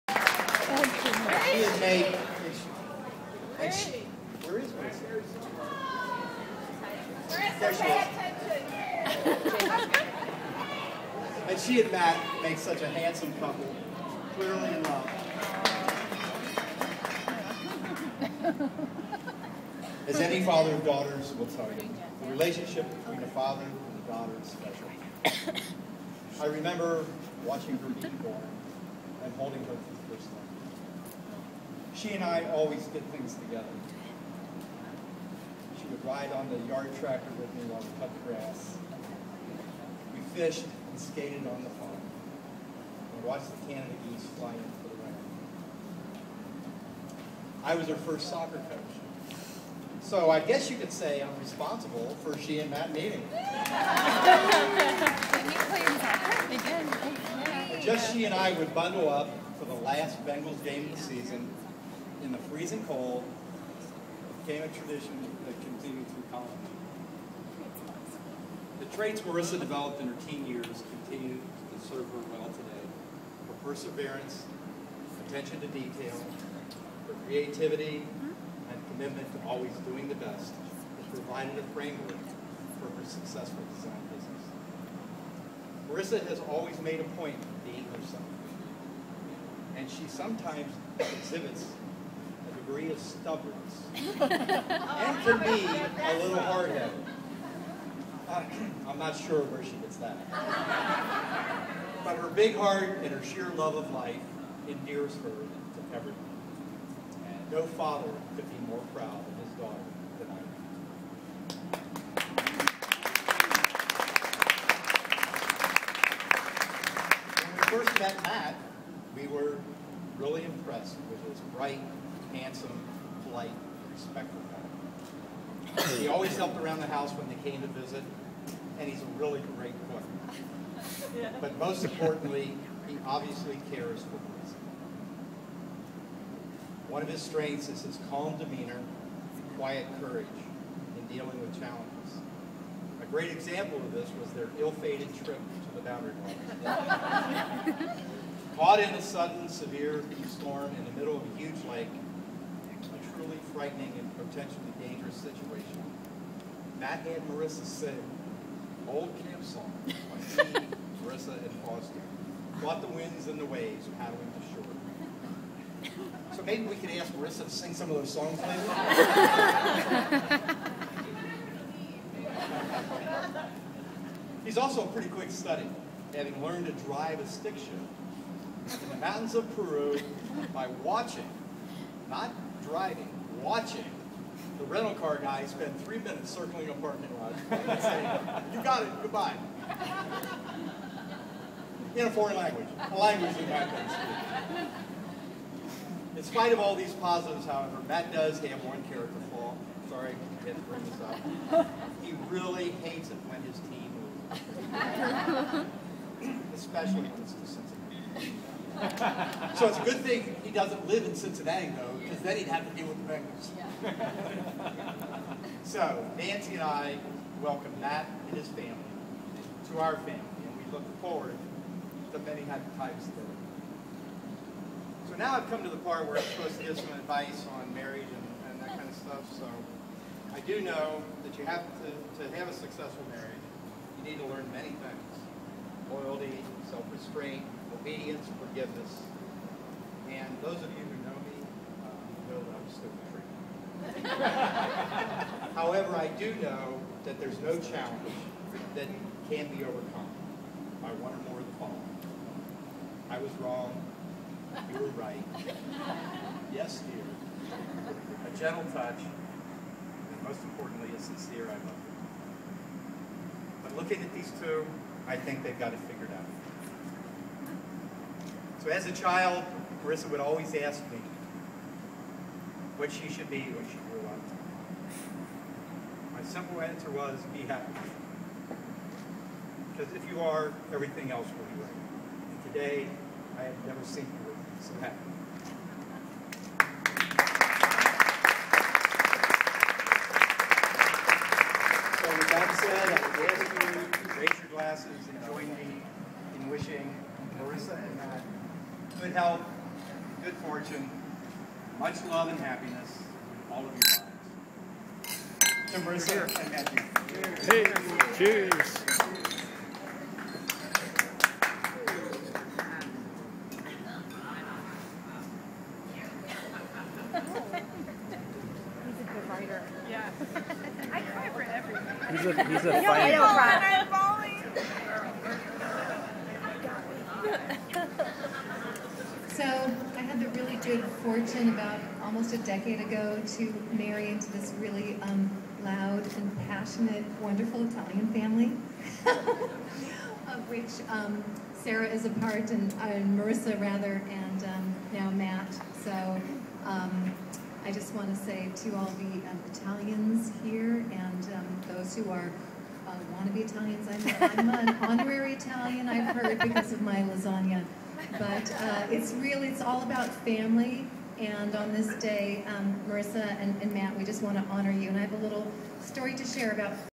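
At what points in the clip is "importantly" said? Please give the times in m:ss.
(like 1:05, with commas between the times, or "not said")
2:11, 4:20.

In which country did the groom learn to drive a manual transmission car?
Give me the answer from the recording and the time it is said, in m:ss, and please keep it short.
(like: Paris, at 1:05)
Peru, at 2:59.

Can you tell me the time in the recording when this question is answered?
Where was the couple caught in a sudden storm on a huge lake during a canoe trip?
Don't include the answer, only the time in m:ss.
2:25.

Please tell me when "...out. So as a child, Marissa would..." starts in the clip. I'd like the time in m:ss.
4:26.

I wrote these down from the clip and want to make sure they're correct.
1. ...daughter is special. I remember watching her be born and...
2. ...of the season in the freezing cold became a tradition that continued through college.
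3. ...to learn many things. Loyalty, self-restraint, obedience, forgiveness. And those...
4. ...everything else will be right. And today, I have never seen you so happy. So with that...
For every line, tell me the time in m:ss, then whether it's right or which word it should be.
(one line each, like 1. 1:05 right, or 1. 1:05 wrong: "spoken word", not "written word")
1. 0:24 right
2. 1:00 right
3. 3:54 right
4. 4:40 right.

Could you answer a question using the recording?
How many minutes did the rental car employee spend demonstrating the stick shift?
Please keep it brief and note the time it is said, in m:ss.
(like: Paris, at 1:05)
3, at 3:05.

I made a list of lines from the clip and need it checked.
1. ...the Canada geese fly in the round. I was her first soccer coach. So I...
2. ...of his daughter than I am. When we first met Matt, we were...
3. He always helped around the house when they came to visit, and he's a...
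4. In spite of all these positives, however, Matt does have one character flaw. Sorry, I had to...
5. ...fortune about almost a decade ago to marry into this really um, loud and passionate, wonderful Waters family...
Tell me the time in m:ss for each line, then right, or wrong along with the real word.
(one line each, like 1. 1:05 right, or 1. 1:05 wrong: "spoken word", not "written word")
1. 0:43 right
2. 1:49 right
3. 2:05 right
4. 3:16 right
5. 5:31 wrong: "Italian", not "Waters".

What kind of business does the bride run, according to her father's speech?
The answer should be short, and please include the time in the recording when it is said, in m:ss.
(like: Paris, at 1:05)
Design business, at 1:23.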